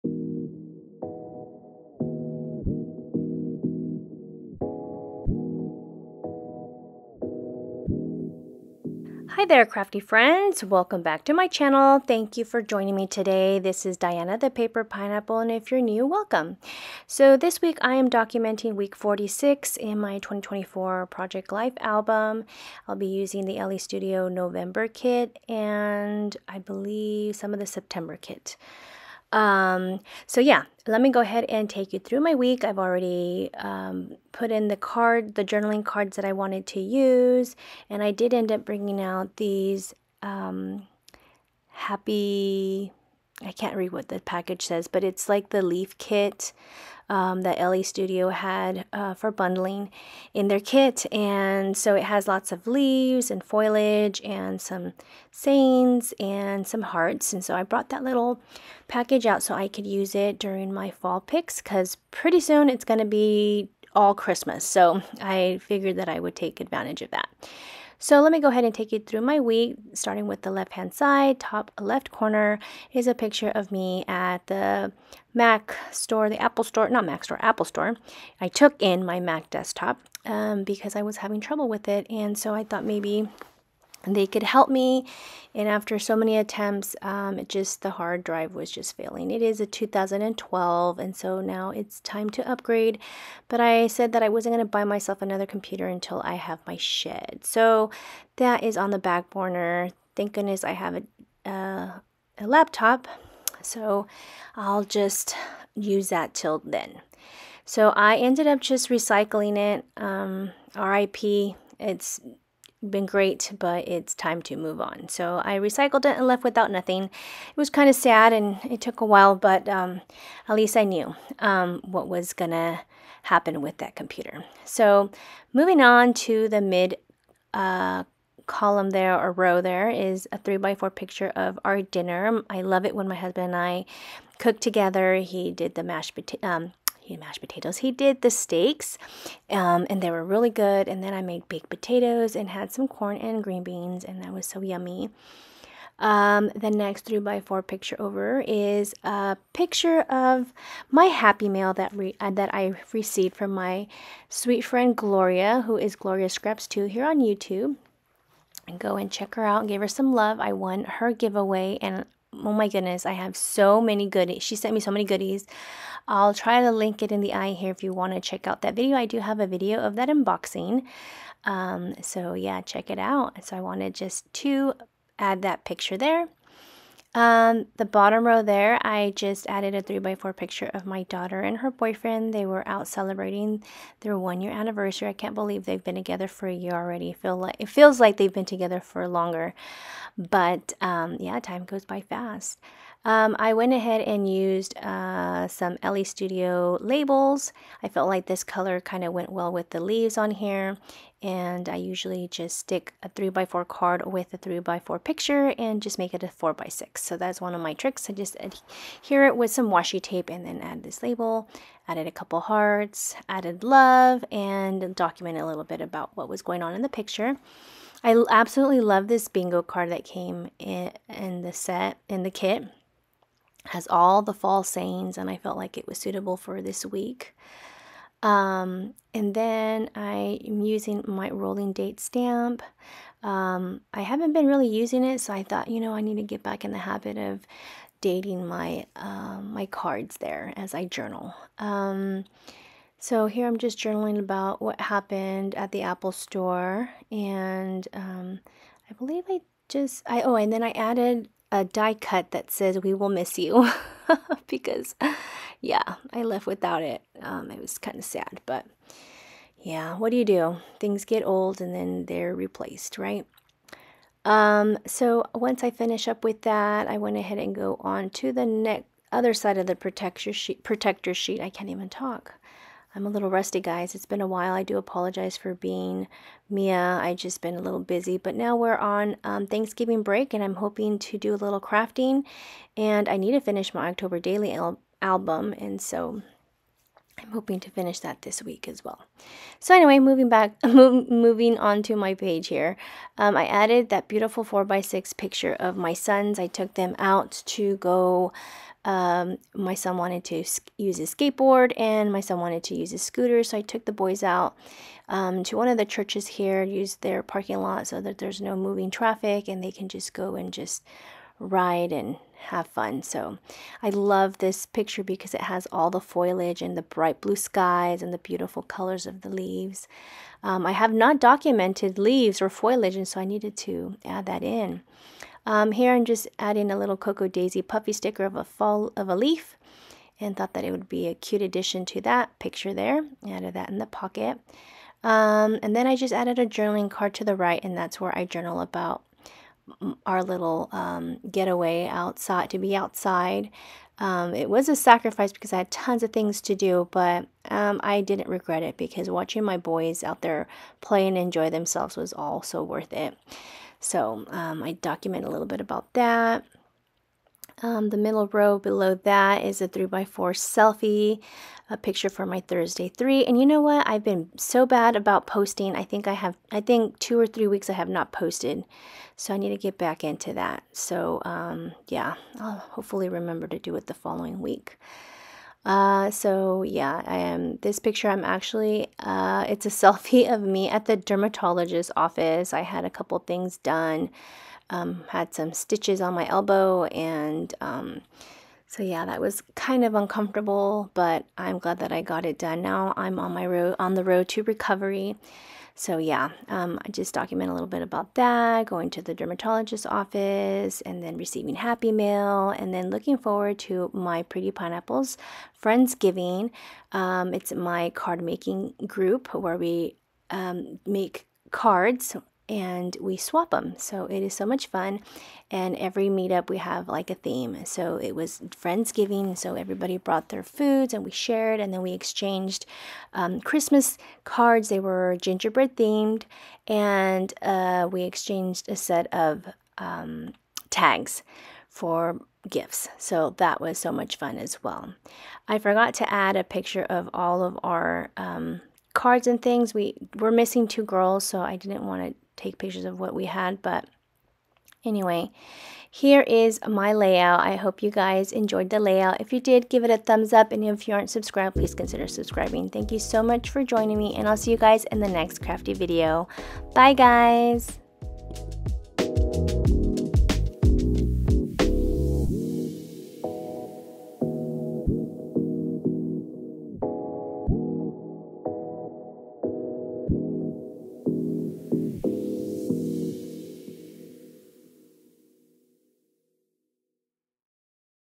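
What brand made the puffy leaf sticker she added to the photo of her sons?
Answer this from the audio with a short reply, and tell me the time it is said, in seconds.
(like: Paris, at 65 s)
Cocoa Daisy, at 326 s.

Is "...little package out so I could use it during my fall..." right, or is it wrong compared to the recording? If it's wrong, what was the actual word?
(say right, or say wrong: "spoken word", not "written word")
right.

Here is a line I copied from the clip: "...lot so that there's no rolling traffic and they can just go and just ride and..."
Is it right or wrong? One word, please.
wrong.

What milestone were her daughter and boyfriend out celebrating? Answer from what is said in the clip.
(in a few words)
One year anniversary.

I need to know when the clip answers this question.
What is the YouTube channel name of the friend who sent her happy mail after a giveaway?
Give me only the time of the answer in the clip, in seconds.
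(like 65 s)
155 s.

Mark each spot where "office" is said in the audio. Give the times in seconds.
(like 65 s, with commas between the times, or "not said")
381 s, 399 s.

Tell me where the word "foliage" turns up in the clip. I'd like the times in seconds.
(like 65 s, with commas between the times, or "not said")
53 s, 315 s, 322 s.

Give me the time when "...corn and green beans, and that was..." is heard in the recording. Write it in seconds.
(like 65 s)
142 s.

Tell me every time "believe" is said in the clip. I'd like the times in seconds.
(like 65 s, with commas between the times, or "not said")
26 s, 185 s, 248 s.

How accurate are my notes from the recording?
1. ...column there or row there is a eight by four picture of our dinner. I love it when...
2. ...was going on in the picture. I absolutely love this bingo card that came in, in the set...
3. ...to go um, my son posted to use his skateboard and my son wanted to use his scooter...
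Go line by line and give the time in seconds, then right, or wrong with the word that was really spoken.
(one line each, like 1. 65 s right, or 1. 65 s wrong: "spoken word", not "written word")
1. 128 s wrong: "three", not "eight"
2. 216 s right
3. 297 s wrong: "wanted", not "posted".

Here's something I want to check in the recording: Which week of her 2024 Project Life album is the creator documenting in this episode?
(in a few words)
46.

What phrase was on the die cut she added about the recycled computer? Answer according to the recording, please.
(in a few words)
We will miss you.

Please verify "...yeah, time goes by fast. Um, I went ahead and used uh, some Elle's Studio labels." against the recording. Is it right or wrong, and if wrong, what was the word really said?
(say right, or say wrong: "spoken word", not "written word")
right.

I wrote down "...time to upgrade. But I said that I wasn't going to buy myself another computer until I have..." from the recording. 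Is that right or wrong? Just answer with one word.
right.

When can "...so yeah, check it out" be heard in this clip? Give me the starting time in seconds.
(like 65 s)
172 s.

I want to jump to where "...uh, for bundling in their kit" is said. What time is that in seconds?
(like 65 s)
48 s.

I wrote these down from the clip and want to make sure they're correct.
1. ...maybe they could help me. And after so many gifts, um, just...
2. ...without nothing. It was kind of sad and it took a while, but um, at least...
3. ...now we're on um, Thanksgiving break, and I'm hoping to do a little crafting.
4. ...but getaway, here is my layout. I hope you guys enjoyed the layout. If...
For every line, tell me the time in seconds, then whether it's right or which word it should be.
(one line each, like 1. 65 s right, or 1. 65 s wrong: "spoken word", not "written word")
1. 82 s wrong: "attempts", not "gifts"
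2. 116 s right
3. 278 s right
4. 443 s wrong: "anyway", not "getaway".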